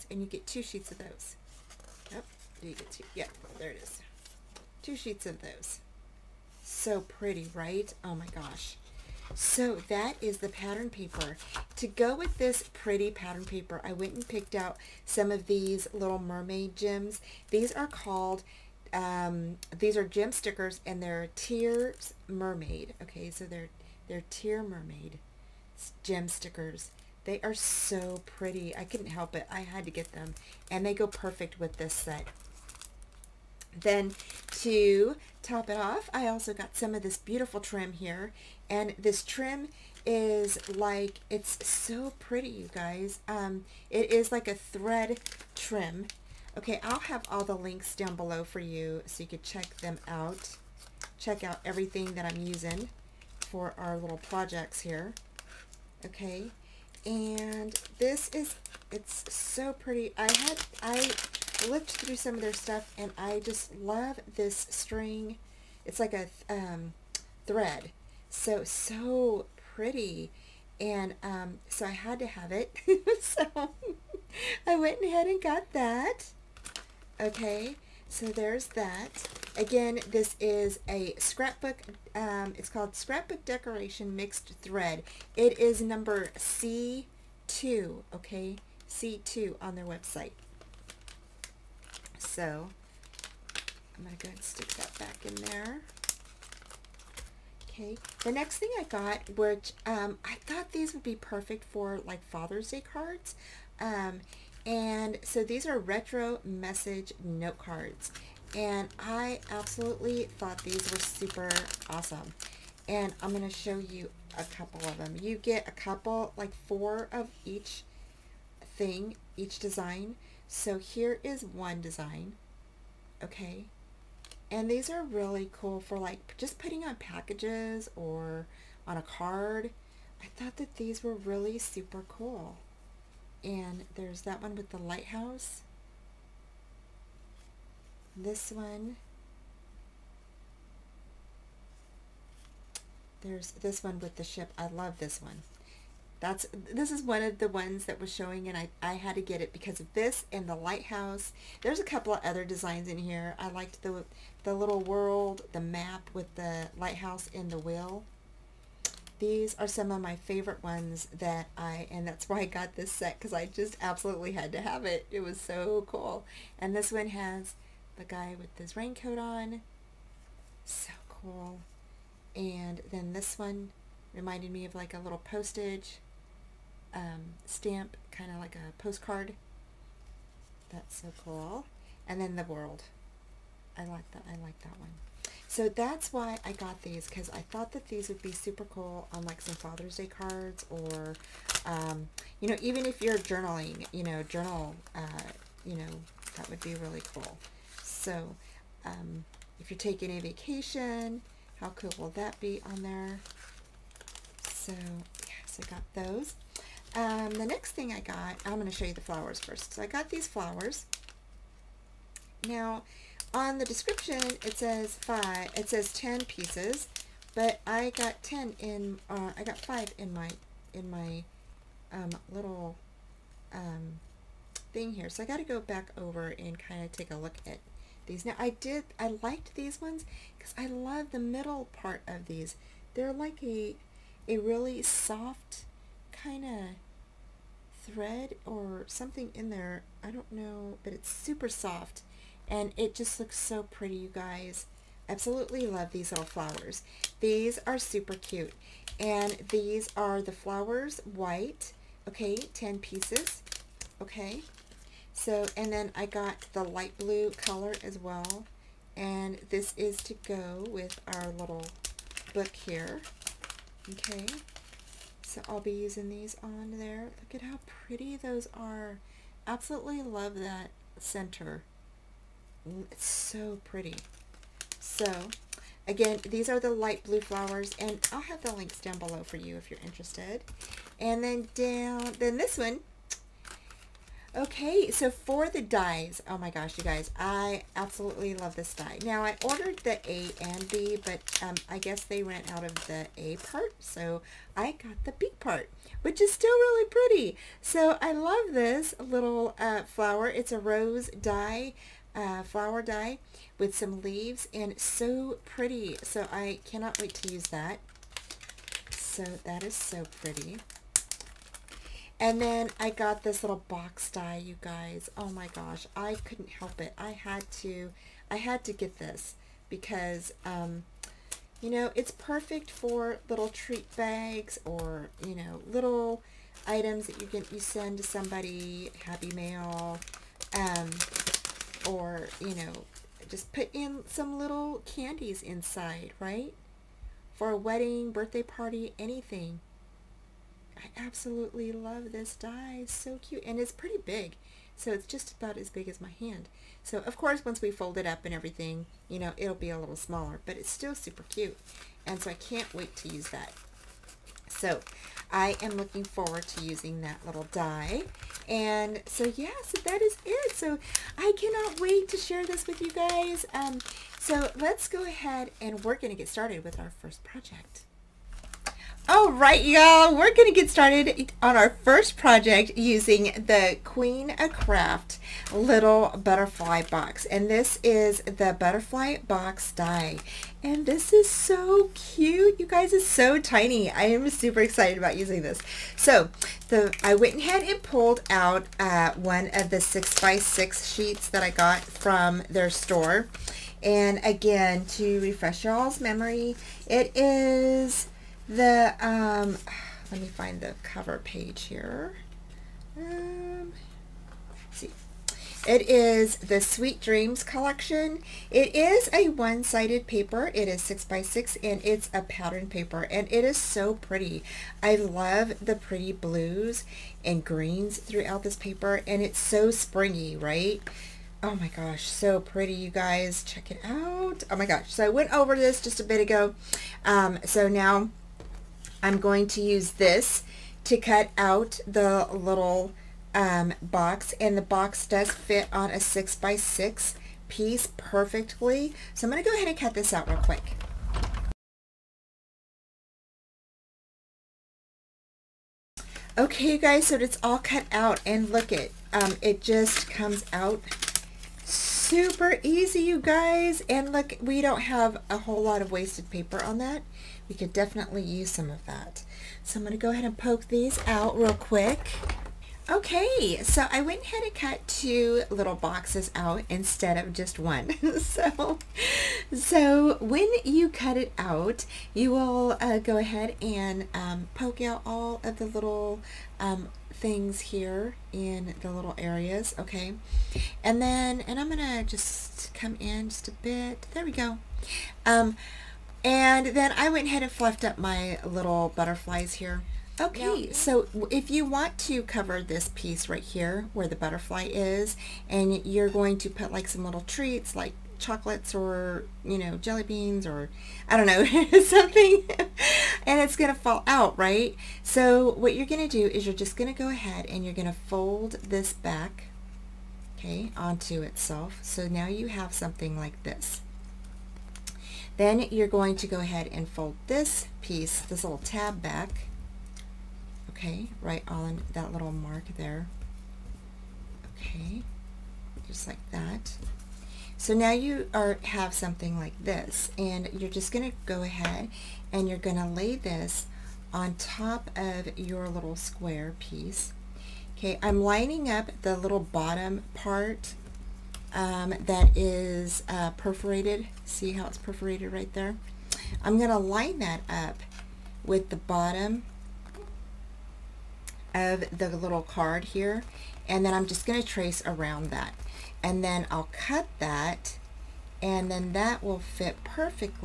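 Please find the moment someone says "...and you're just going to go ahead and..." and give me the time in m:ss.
8:50.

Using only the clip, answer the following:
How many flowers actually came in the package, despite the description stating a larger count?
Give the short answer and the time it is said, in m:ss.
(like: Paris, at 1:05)
5, at 3:39.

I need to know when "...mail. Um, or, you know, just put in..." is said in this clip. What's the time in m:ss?
5:29.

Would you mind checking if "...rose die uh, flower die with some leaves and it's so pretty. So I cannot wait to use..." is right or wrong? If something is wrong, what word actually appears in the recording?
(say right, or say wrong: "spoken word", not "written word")
right.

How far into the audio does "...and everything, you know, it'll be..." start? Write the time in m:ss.
5:48.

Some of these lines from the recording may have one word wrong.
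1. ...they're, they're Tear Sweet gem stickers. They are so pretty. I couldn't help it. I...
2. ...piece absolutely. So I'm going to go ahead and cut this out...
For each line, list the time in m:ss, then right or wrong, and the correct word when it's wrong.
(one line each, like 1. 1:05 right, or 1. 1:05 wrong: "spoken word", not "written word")
1. 0:23 wrong: "Mermaid", not "Sweet"
2. 7:17 wrong: "perfectly", not "absolutely".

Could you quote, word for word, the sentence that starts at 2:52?
And then this one reminded me of like a little postage um, stamp, kind of like a postcard.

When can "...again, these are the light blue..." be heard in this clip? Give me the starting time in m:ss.
4:35.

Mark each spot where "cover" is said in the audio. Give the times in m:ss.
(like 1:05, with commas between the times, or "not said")
6:40, 8:12.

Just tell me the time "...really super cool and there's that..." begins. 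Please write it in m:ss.
2:11.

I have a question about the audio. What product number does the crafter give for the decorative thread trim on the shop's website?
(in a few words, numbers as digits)
C2.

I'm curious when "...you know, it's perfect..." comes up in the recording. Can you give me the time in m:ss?
5:21.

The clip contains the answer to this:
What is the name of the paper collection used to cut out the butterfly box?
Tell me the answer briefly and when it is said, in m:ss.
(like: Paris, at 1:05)
Sweet Dreams, at 6:46.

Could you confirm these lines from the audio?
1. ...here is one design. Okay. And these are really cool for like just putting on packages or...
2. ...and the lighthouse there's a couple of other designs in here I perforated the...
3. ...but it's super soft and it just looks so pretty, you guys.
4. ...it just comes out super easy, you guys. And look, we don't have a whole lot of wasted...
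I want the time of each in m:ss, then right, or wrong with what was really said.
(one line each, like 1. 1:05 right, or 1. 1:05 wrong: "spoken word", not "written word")
1. 2:00 right
2. 2:30 wrong: "liked", not "perforated"
3. 4:00 right
4. 7:29 right.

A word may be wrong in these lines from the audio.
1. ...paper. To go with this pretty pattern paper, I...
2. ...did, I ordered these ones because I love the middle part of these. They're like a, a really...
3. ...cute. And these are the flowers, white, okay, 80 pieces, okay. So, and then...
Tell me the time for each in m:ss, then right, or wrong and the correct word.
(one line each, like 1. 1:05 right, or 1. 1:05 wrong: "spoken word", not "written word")
1. 0:10 right
2. 3:48 wrong: "liked", not "ordered"
3. 4:08 wrong: "10", not "80".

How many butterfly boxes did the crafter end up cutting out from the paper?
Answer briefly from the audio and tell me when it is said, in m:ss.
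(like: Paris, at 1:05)
2, at 7:44.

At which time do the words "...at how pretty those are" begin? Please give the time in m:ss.
4:27.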